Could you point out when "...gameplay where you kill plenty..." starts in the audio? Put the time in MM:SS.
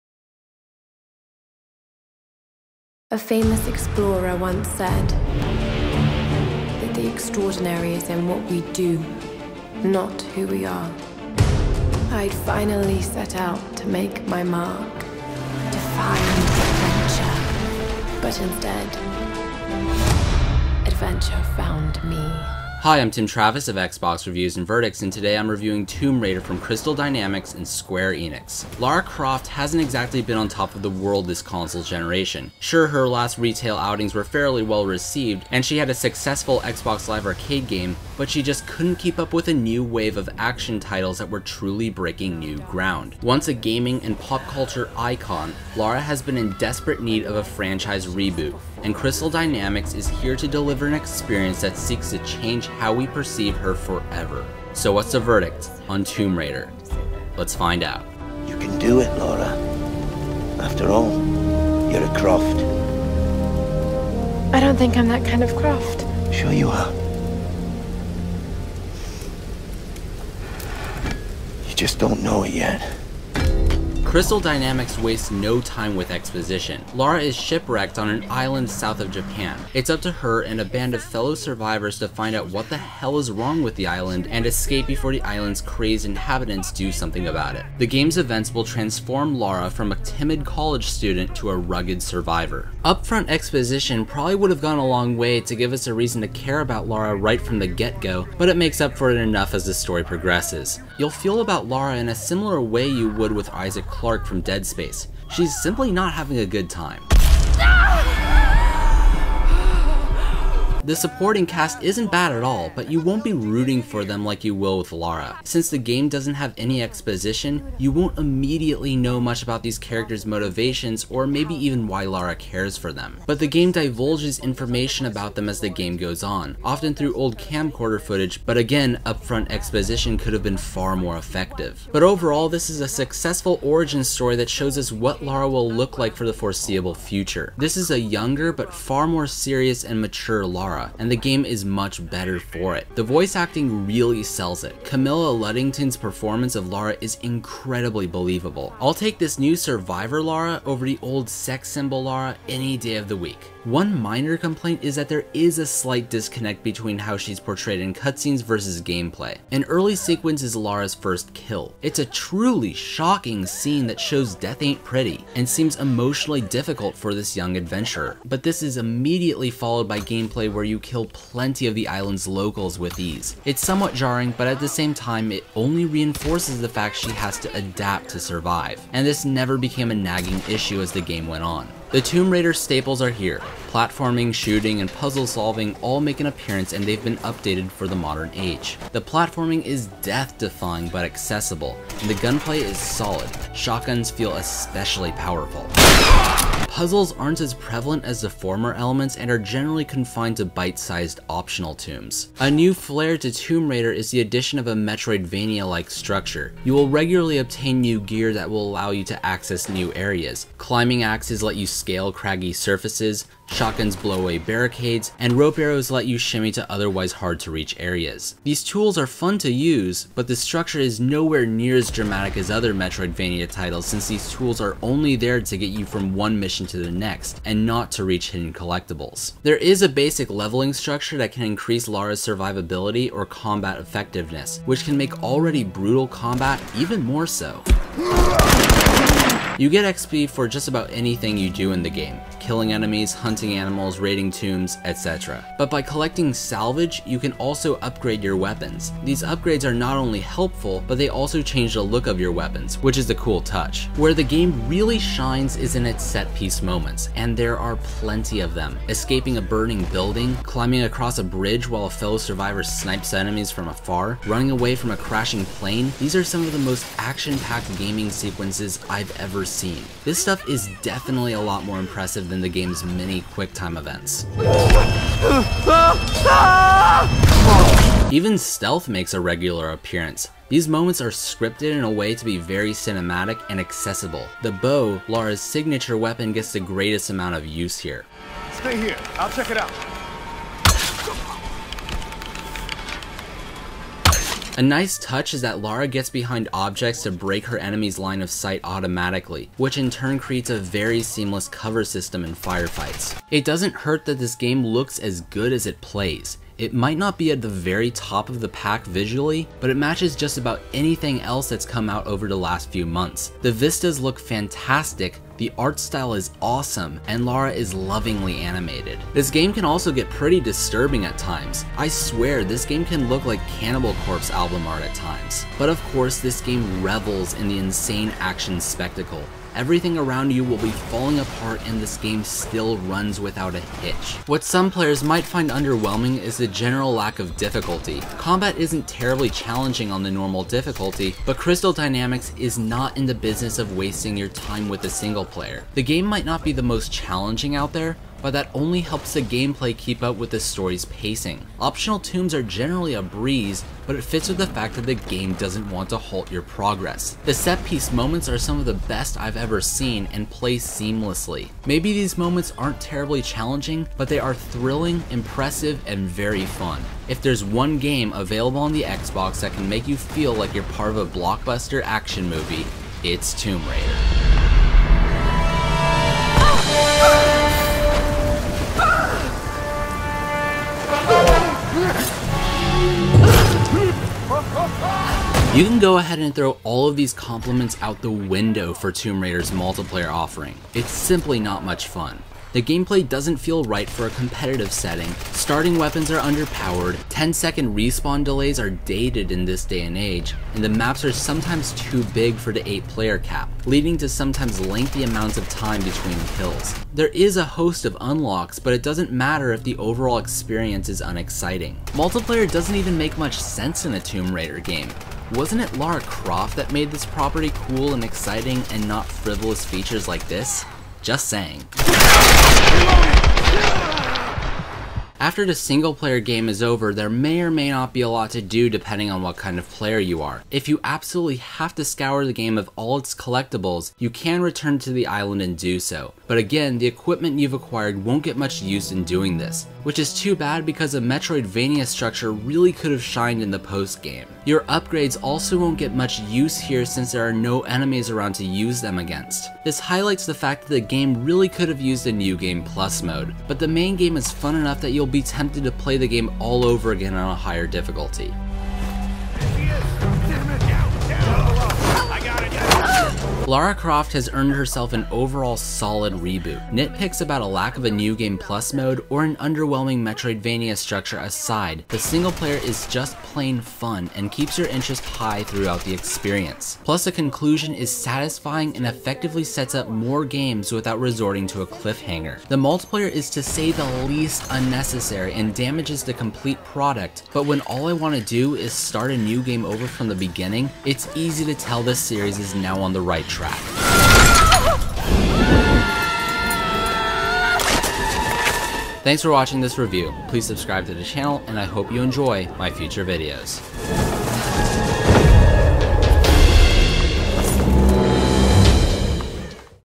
02:49.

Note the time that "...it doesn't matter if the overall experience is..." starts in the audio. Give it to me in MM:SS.
06:48.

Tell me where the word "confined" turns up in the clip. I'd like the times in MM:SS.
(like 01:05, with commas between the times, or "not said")
03:19.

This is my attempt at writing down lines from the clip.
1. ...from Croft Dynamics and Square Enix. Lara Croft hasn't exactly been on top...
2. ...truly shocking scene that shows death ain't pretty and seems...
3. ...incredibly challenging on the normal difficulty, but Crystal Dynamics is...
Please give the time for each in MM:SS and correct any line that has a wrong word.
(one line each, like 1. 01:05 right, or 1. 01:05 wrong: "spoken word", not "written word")
1. 00:26 wrong: "Crystal", not "Croft"
2. 02:42 right
3. 05:38 wrong: "terribly", not "incredibly".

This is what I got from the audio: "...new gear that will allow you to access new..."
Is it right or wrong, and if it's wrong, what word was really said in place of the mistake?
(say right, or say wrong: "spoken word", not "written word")
right.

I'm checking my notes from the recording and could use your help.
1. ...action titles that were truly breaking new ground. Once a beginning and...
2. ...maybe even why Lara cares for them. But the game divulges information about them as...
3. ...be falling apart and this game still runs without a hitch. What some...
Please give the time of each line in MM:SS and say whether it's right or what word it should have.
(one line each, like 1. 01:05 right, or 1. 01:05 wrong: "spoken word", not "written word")
1. 00:40 wrong: "gaming", not "beginning"
2. 02:01 right
3. 05:30 right.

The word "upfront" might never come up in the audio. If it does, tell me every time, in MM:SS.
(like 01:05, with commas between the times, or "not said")
01:32, 02:09.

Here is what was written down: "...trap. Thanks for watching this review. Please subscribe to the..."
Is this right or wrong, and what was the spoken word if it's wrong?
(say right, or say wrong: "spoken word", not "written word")
right.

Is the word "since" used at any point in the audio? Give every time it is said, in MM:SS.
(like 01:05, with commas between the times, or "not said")
01:55, 03:43, 07:26.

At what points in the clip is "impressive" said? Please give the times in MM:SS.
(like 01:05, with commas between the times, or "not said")
04:31, 06:05.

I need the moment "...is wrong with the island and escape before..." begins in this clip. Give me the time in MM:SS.
01:23.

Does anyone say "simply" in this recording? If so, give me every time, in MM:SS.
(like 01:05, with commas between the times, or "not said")
01:45, 06:30.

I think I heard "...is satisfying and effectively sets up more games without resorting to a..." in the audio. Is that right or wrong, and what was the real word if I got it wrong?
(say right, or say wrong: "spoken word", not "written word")
right.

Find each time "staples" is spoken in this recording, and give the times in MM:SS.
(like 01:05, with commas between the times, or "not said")
03:02.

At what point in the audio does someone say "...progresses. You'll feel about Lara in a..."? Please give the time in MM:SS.
01:40.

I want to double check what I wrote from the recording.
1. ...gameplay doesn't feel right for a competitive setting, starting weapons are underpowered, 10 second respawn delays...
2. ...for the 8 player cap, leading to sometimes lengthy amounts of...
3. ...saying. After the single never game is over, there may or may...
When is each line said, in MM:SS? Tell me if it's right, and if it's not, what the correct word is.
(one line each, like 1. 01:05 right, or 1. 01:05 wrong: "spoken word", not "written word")
1. 06:32 right
2. 06:42 right
3. 07:01 wrong: "player", not "never".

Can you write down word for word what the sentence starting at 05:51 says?
Optional tombs are generally a breeze, but it fits with the fact that the game doesn't want to halt your progress.